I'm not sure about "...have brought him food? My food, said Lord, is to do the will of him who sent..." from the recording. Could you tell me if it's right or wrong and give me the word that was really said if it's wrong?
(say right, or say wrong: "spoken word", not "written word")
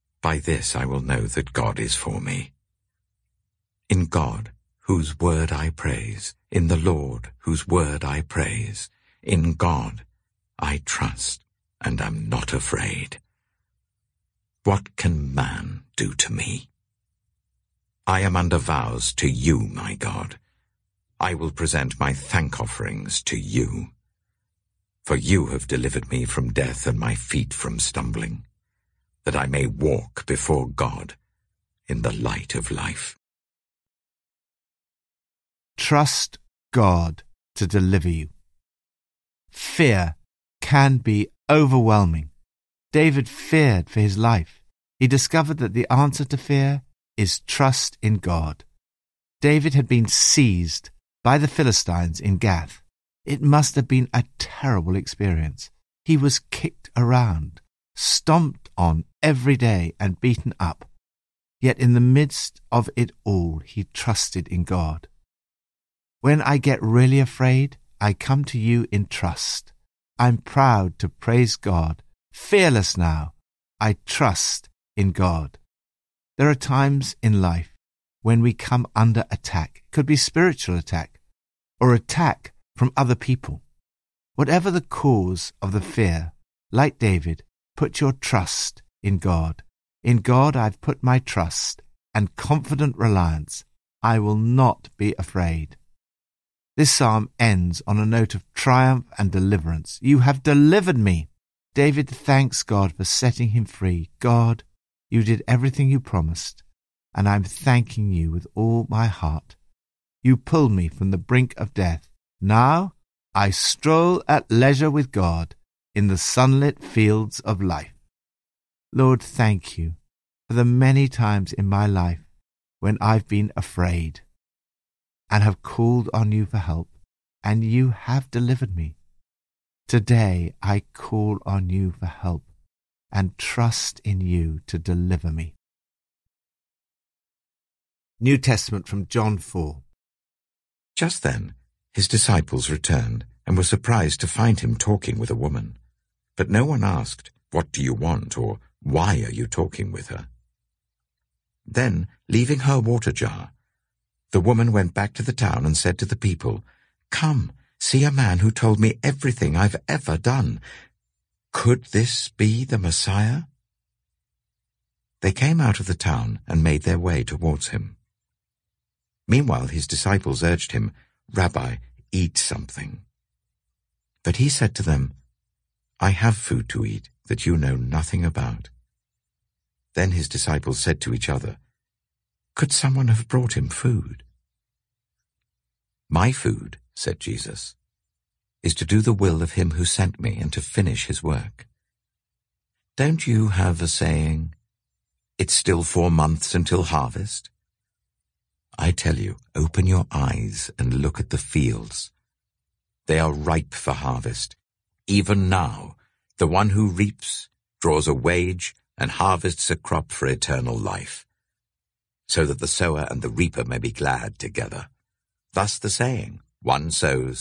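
wrong: "Jesus", not "Lord".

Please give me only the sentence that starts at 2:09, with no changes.
Today I call on you for help and trust in you to deliver me.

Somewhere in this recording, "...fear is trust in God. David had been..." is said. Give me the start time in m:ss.
0:46.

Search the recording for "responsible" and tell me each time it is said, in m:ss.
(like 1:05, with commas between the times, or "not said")
not said.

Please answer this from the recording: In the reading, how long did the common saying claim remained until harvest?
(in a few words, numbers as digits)
4 months.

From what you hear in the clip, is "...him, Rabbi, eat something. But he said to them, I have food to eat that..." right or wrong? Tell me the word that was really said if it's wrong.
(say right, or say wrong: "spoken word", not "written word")
right.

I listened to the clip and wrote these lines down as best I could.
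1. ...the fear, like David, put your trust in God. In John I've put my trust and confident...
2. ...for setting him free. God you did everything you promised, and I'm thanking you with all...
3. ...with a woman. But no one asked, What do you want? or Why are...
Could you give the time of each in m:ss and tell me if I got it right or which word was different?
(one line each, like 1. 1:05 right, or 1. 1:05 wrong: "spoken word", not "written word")
1. 1:25 wrong: "God", not "John"
2. 1:42 right
3. 2:25 right.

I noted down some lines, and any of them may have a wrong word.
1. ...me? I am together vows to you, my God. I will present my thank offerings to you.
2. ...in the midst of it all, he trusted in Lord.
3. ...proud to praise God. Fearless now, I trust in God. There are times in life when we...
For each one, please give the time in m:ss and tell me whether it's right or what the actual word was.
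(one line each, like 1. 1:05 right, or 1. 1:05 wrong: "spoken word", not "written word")
1. 0:16 wrong: "under", not "together"
2. 1:01 wrong: "God", not "Lord"
3. 1:10 right.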